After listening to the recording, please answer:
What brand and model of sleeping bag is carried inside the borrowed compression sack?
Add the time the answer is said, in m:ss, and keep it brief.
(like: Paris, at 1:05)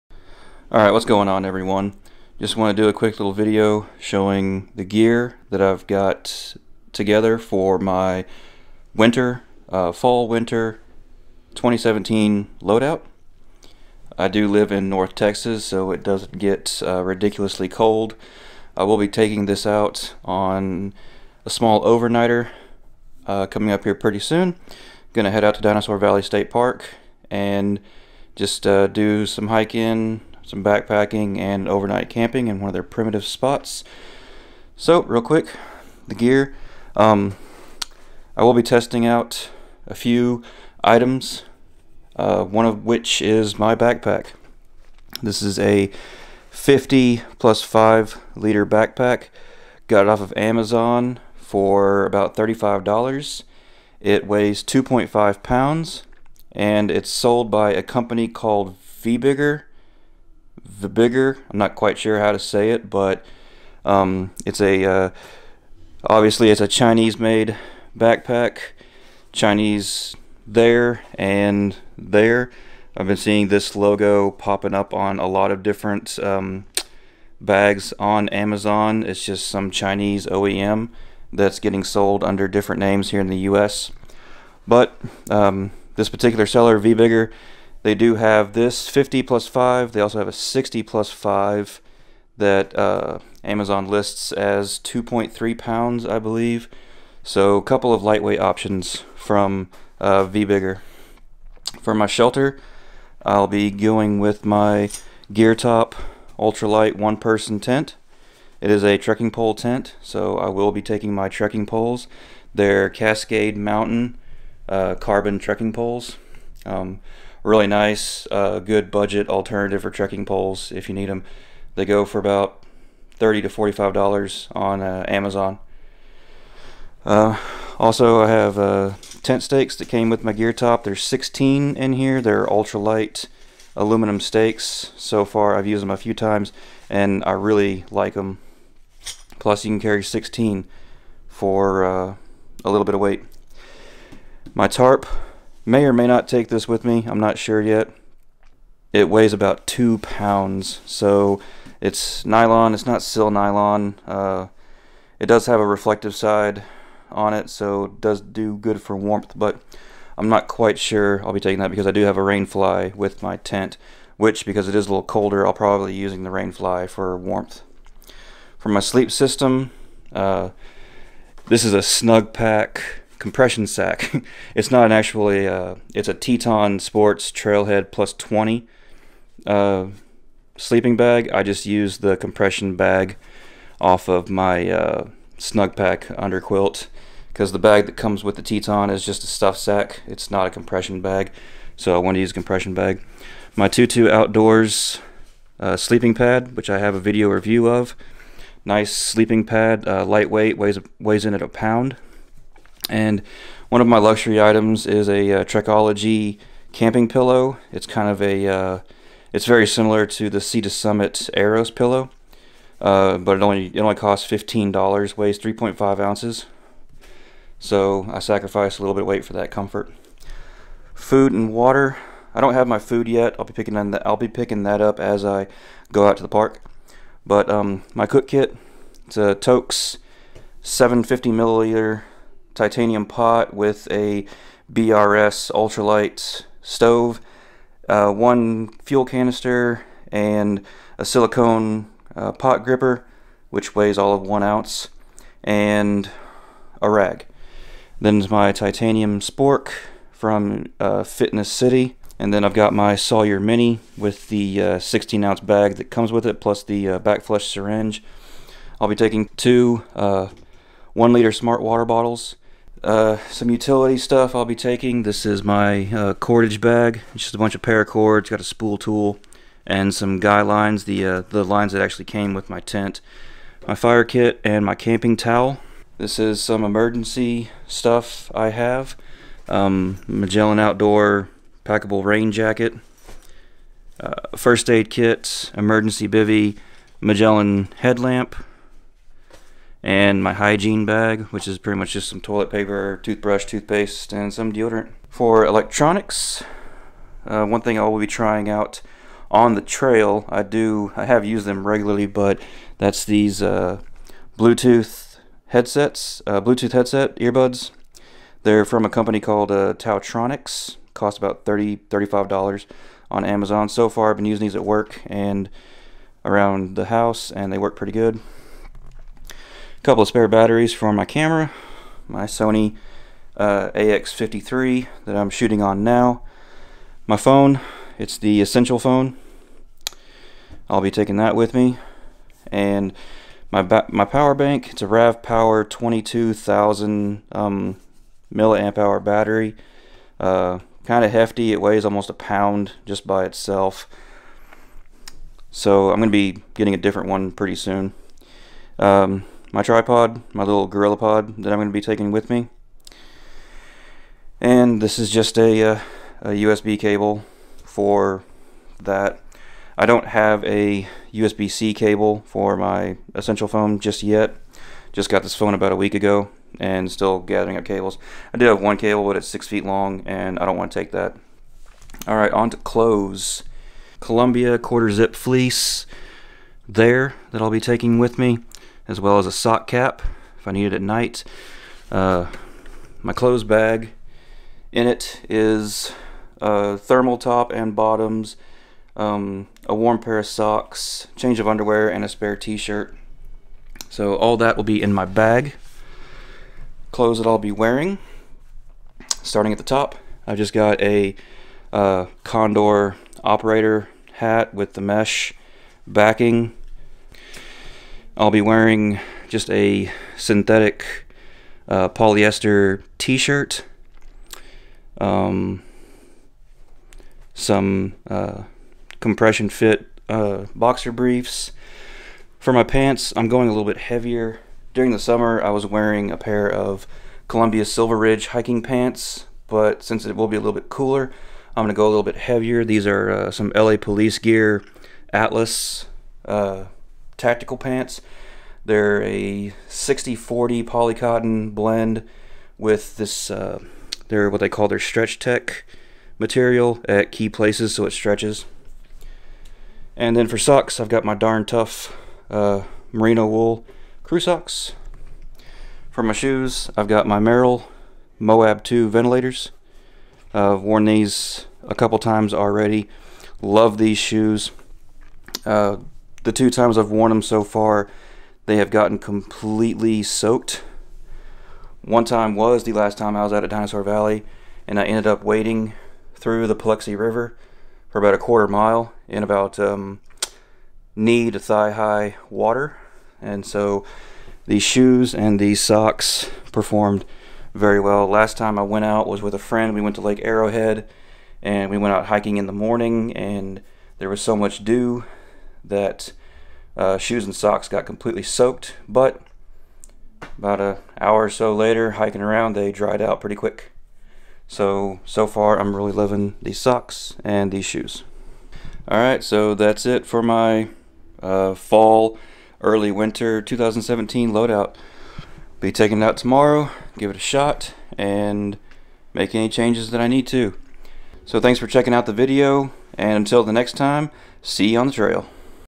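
Teton Sports Trailhead Plus 20, at 2:56.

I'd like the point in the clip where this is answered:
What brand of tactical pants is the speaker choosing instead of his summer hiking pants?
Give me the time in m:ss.
7:13.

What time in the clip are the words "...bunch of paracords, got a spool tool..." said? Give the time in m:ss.
4:27.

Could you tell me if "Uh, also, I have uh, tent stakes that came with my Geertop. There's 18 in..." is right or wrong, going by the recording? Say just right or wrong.
wrong.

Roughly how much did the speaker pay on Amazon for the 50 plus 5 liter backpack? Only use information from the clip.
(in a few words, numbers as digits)
$35.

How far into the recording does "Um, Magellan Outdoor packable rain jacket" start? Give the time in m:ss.
4:39.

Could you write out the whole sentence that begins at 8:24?
So, so far, I'm really loving these socks and these shoes.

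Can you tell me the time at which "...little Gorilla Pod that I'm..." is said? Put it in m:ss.
5:50.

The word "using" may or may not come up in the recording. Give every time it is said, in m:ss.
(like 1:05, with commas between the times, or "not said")
2:45, 5:14.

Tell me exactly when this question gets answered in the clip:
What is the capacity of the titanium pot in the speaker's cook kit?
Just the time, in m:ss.
3:50.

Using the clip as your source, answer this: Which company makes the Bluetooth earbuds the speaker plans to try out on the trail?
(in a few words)
TaoTronics.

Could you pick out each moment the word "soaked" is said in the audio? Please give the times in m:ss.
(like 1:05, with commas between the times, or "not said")
7:50, 8:18.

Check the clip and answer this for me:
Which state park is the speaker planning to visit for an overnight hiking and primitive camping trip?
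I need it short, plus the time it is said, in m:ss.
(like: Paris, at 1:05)
Dinosaur Valley State Park, at 0:25.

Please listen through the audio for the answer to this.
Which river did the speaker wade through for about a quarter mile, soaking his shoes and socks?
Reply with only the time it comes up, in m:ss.
7:56.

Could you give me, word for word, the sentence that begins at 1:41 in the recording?
For my shelter, I'll be going with my Geertop Ultralight one-person tent.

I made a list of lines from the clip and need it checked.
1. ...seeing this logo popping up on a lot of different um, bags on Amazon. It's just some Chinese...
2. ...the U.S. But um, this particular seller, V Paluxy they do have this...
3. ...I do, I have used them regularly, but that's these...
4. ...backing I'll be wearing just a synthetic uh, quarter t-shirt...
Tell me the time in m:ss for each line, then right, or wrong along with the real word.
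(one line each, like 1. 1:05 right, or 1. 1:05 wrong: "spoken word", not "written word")
1. 1:13 right
2. 1:23 wrong: "Bigger", not "Paluxy"
3. 5:00 right
4. 6:45 wrong: "polyester", not "quarter".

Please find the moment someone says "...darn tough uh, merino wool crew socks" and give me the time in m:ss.
7:31.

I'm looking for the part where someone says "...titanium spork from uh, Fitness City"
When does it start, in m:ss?
4:08.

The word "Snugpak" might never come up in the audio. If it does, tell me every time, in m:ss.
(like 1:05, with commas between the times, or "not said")
2:51, 3:05.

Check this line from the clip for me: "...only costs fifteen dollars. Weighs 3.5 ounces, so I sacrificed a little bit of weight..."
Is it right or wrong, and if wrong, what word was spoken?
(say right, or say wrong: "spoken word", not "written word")
right.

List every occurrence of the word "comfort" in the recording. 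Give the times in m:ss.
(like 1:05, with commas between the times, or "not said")
3:39.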